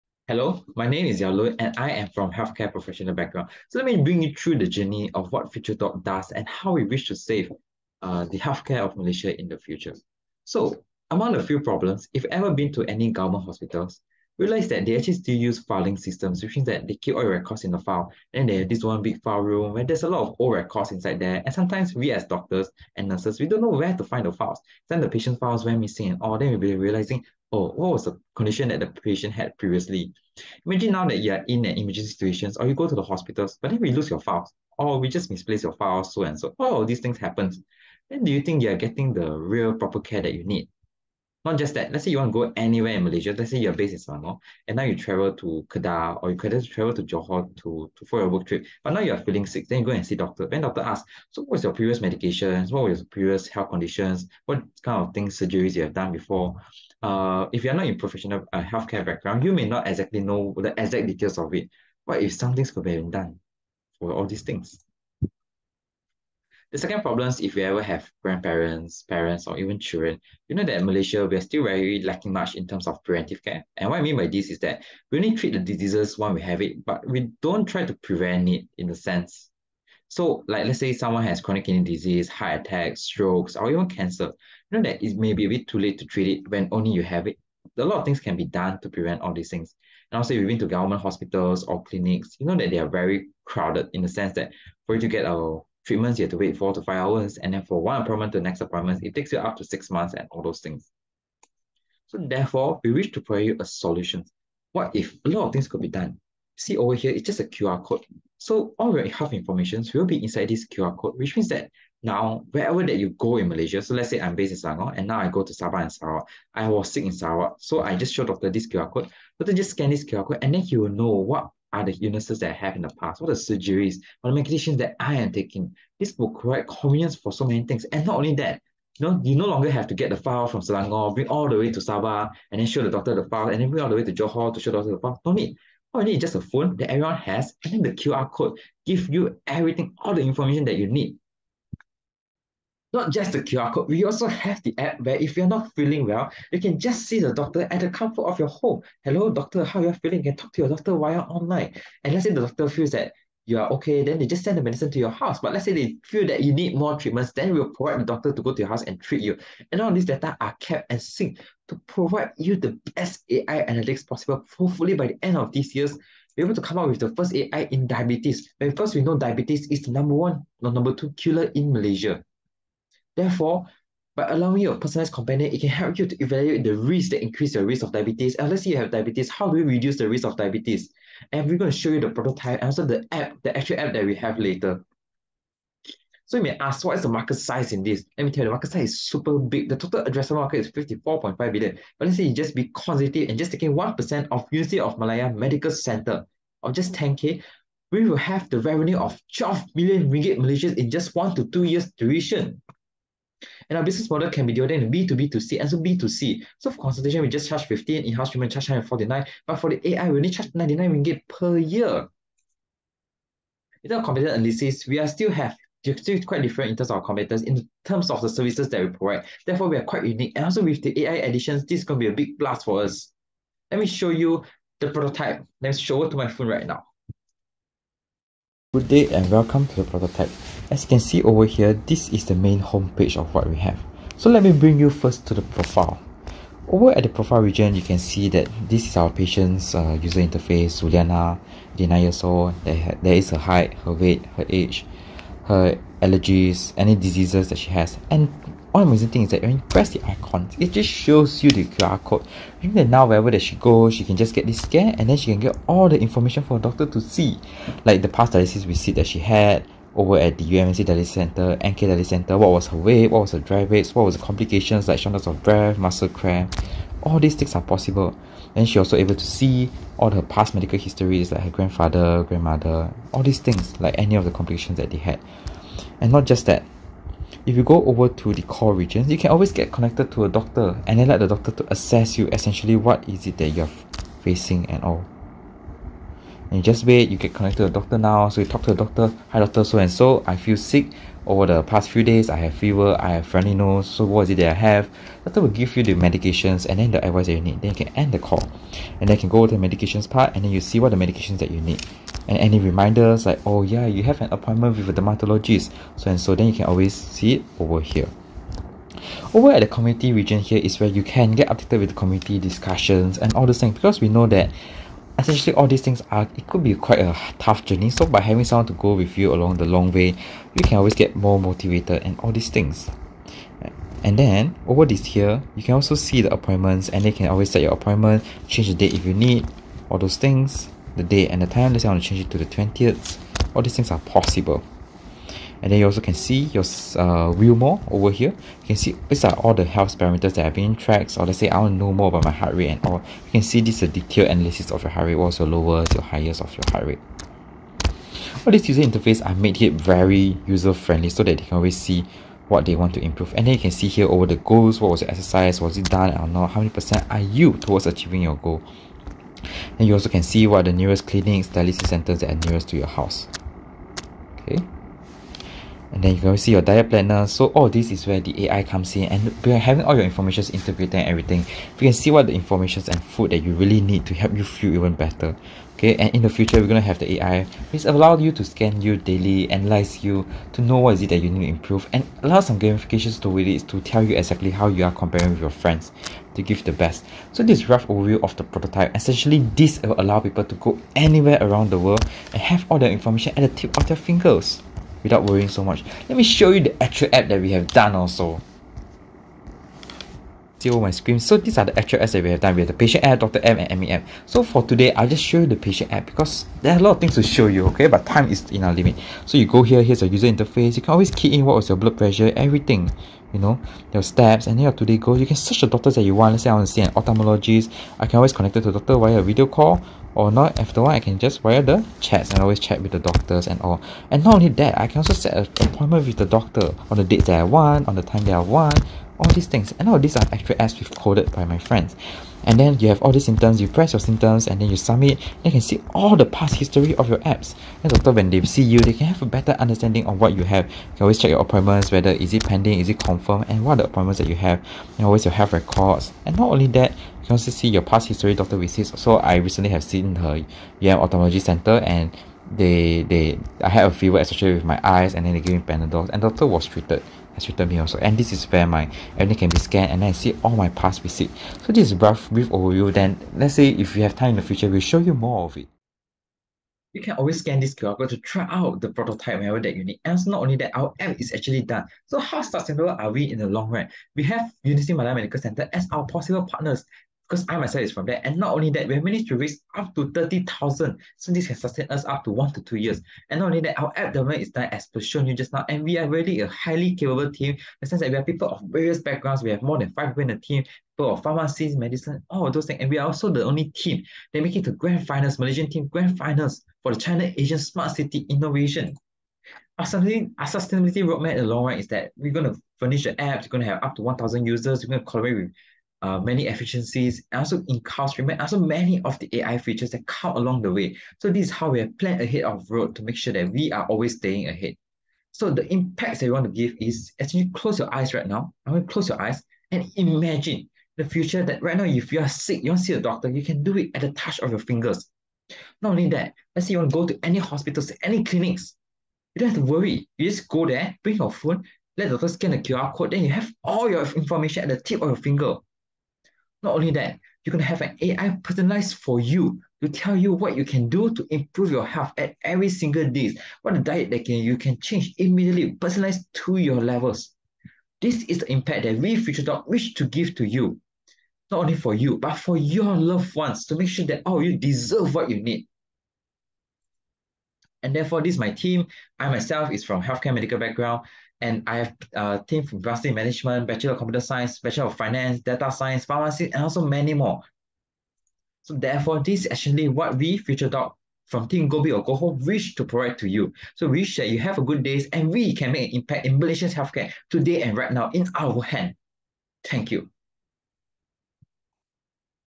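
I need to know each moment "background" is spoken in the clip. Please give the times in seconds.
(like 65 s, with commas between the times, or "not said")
3 s, 59 s, 489 s, 560 s.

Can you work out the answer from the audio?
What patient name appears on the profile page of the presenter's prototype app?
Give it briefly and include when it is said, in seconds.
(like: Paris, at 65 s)
Juliana, at 240 s.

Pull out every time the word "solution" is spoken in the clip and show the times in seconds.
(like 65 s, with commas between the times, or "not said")
103 s.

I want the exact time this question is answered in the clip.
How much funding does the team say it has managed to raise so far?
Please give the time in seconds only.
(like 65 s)
480 s.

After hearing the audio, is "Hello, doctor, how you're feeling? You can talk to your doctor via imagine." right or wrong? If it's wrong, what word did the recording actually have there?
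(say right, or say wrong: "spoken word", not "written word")
wrong: "online", not "imagine".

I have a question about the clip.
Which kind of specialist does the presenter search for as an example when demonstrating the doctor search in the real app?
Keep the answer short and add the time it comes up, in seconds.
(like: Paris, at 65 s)
ophthalmologist, at 416 s.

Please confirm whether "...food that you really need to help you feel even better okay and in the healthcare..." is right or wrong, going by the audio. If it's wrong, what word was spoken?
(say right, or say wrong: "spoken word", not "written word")
wrong: "future", not "healthcare".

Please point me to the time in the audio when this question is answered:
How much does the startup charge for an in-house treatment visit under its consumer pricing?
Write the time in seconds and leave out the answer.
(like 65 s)
208 s.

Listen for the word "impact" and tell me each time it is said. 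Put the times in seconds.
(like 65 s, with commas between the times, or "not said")
515 s, 548 s, 575 s.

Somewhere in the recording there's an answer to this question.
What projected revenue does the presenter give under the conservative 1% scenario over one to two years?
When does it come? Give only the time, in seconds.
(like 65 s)
199 s.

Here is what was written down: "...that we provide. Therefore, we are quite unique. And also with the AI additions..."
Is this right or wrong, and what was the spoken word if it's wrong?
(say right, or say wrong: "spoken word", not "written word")
right.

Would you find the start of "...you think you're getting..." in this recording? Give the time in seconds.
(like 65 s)
38 s.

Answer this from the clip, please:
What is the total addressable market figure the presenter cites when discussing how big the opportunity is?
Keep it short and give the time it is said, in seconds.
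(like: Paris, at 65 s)
54.5 billion, at 190 s.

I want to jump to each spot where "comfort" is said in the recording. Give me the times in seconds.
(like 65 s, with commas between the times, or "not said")
147 s.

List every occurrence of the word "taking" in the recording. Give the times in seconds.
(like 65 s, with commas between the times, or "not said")
125 s, 193 s.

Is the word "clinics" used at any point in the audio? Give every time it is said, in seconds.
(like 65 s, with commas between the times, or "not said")
91 s, 361 s, 528 s.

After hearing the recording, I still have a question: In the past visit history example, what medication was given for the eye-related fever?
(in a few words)
Panadol.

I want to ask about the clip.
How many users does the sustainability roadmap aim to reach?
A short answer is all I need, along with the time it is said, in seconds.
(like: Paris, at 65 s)
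1,000, at 504 s.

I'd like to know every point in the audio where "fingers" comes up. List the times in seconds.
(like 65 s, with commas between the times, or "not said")
393 s, 524 s, 535 s.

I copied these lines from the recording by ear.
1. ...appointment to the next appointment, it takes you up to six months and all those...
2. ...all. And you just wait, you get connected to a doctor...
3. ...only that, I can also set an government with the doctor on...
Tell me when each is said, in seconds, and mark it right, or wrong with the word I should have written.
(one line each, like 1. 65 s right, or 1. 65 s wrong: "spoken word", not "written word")
1. 98 s right
2. 284 s right
3. 424 s wrong: "appointment", not "government".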